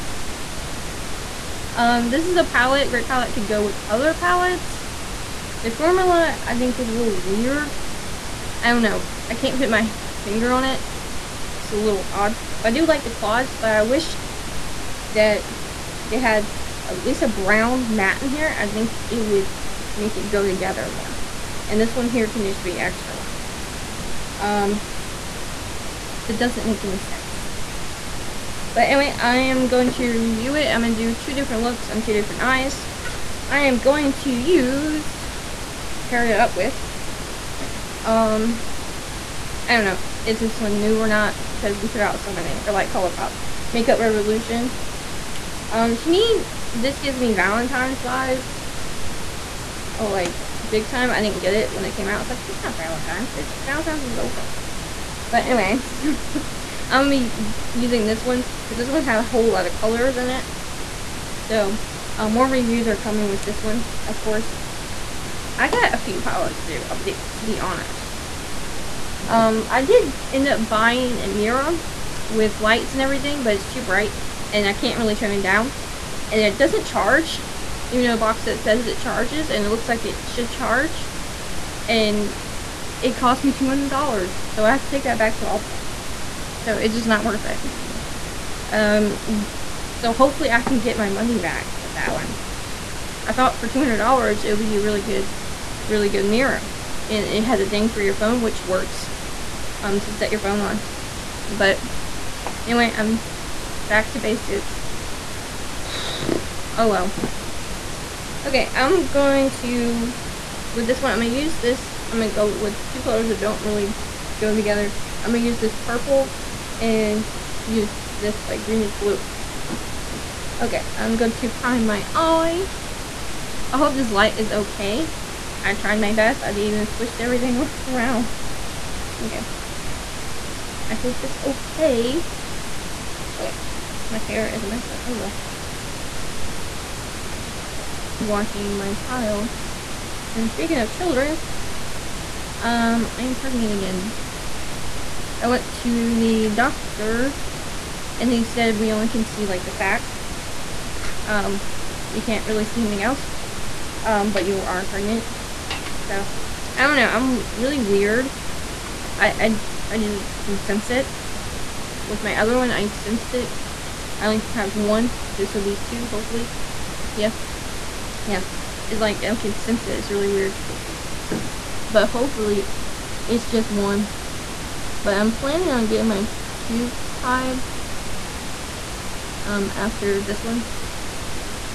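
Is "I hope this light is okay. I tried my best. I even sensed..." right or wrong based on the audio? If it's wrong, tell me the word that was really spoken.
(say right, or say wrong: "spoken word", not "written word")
wrong: "switched", not "sensed".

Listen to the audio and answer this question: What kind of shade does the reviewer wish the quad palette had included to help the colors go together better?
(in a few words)
brown matte.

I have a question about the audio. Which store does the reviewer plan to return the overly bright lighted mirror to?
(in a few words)
Ulta.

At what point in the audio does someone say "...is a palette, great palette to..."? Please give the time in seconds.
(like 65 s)
2 s.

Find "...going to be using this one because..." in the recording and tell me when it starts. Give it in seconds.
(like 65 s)
57 s.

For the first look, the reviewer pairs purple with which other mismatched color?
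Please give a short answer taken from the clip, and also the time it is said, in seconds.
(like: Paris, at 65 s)
greenish blue, at 118 s.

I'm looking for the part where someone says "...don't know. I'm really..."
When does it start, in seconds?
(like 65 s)
156 s.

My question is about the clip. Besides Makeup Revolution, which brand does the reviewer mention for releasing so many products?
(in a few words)
Colourpop.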